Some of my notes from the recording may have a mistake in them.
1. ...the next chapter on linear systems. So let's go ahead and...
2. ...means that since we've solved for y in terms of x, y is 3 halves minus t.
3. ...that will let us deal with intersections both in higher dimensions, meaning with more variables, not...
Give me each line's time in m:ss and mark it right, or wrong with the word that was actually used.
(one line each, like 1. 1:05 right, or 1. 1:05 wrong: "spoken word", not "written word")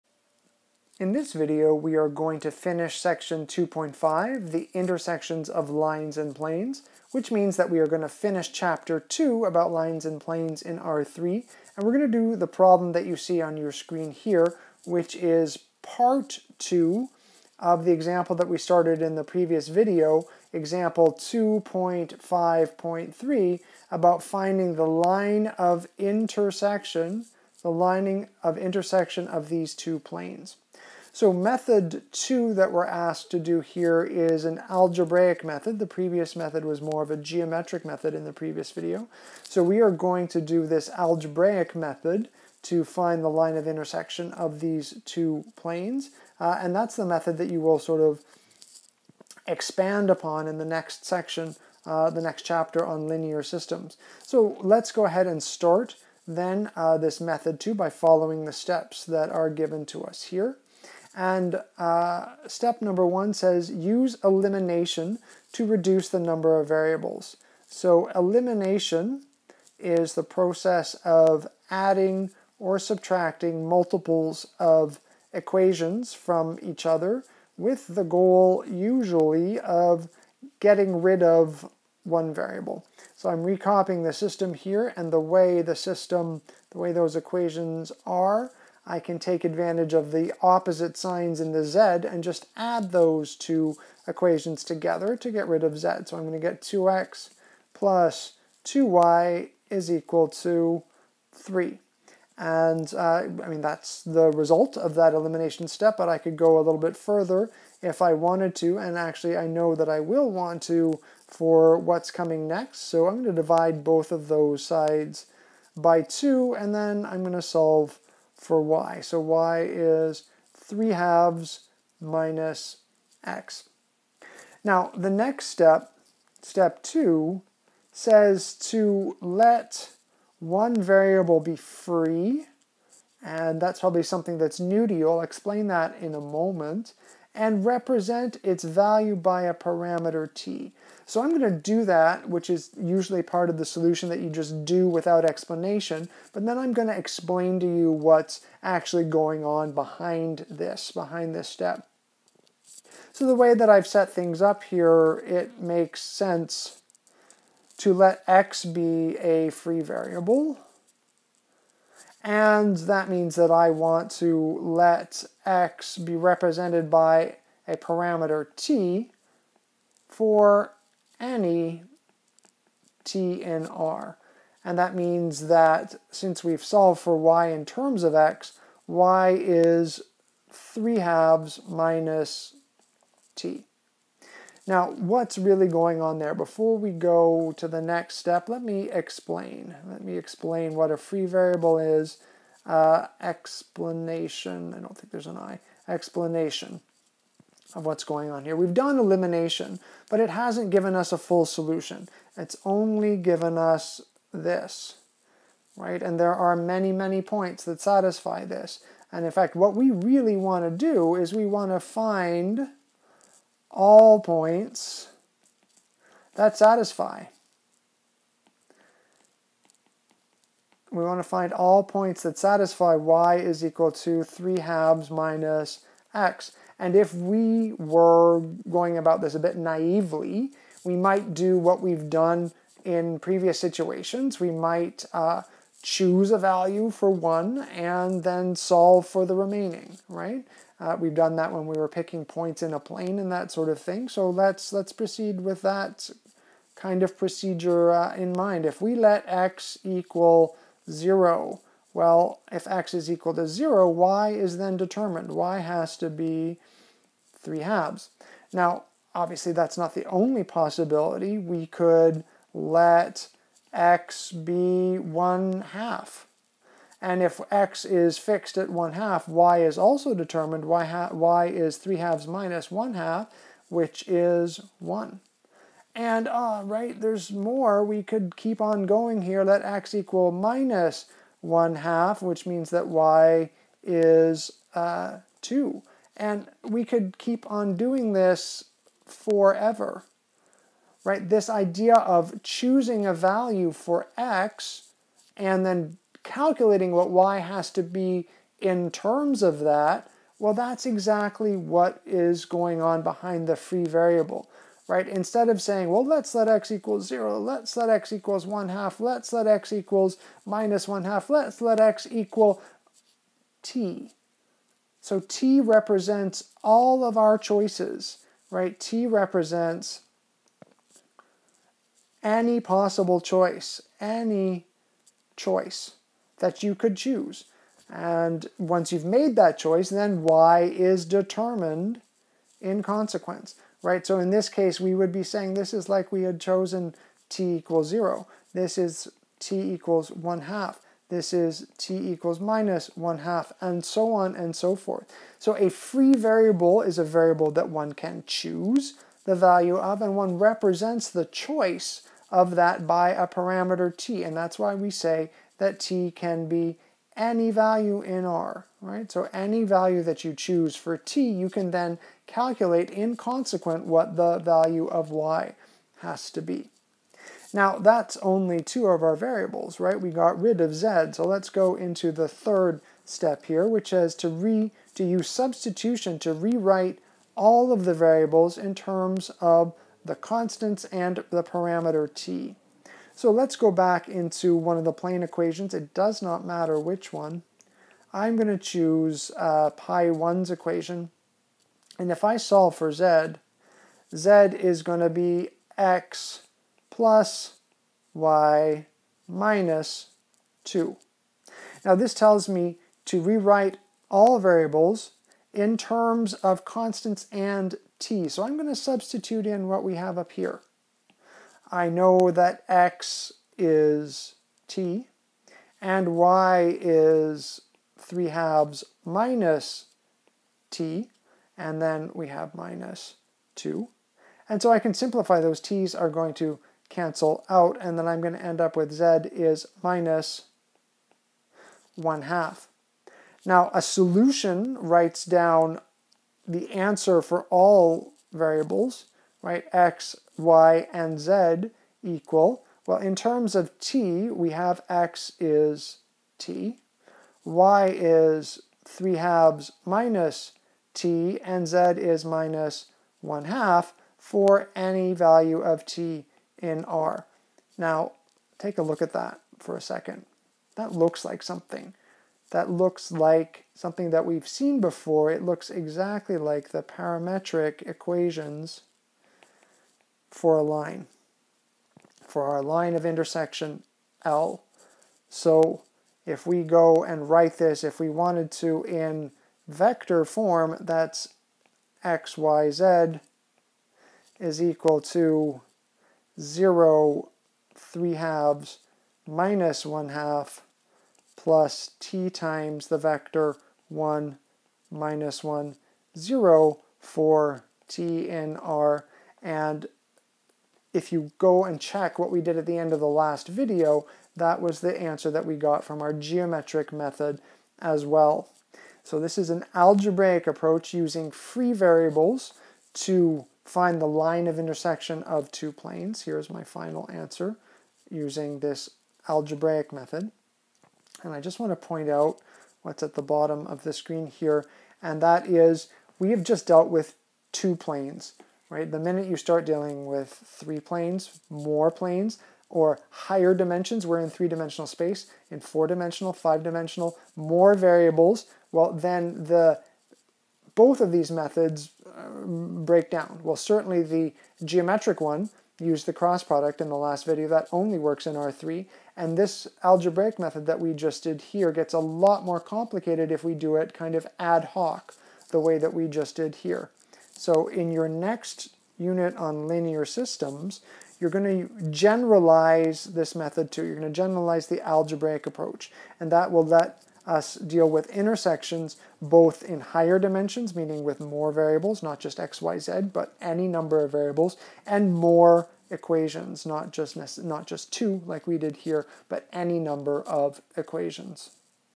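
1. 0:52 right
2. 2:54 right
3. 9:26 right.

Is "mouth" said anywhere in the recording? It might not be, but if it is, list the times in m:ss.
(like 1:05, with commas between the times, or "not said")
not said.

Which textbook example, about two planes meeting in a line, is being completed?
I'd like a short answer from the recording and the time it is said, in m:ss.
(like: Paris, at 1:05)
2.5.3, at 0:20.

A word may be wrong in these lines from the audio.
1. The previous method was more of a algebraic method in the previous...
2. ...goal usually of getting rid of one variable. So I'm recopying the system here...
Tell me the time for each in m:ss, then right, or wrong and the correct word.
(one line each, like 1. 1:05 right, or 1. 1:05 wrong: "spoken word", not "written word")
1. 0:35 wrong: "geometric", not "algebraic"
2. 1:18 right.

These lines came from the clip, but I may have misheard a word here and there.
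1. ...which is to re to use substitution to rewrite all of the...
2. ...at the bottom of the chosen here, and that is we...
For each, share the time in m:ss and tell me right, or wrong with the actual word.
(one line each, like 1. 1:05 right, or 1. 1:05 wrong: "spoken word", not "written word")
1. 6:13 right
2. 8:43 wrong: "screen", not "chosen".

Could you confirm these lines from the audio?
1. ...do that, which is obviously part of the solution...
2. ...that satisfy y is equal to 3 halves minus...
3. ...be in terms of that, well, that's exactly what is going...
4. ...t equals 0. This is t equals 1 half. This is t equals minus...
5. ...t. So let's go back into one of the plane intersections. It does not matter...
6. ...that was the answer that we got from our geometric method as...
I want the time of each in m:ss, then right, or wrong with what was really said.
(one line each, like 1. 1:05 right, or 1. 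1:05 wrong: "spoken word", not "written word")
1. 2:21 wrong: "usually", not "obviously"
2. 3:42 right
3. 4:57 right
4. 5:37 right
5. 6:22 wrong: "equations", not "intersections"
6. 8:24 right.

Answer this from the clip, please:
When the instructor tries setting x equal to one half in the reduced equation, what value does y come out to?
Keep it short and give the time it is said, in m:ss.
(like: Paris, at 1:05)
1, at 4:34.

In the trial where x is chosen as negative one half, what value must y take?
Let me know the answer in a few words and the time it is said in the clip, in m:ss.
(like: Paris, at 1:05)
2, at 4:42.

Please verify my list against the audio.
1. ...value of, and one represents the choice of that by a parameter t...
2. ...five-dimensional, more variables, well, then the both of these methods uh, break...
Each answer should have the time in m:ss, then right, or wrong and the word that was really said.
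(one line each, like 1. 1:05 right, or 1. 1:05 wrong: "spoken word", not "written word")
1. 5:49 right
2. 8:56 right.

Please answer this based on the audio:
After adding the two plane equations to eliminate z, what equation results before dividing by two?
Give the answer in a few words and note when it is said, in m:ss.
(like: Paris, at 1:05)
2x + 2y = 3, at 1:36.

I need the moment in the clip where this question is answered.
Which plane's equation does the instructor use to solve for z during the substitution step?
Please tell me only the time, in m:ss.
6:29.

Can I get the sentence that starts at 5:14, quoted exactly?
So t represents all of our choices, right?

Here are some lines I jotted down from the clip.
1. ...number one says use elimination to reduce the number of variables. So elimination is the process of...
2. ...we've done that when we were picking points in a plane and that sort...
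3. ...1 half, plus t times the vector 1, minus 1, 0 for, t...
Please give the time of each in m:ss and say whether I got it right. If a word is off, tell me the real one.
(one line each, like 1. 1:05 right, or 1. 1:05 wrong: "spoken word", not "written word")
1. 1:02 right
2. 4:00 right
3. 8:09 right.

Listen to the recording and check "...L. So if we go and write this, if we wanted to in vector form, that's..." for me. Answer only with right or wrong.
right.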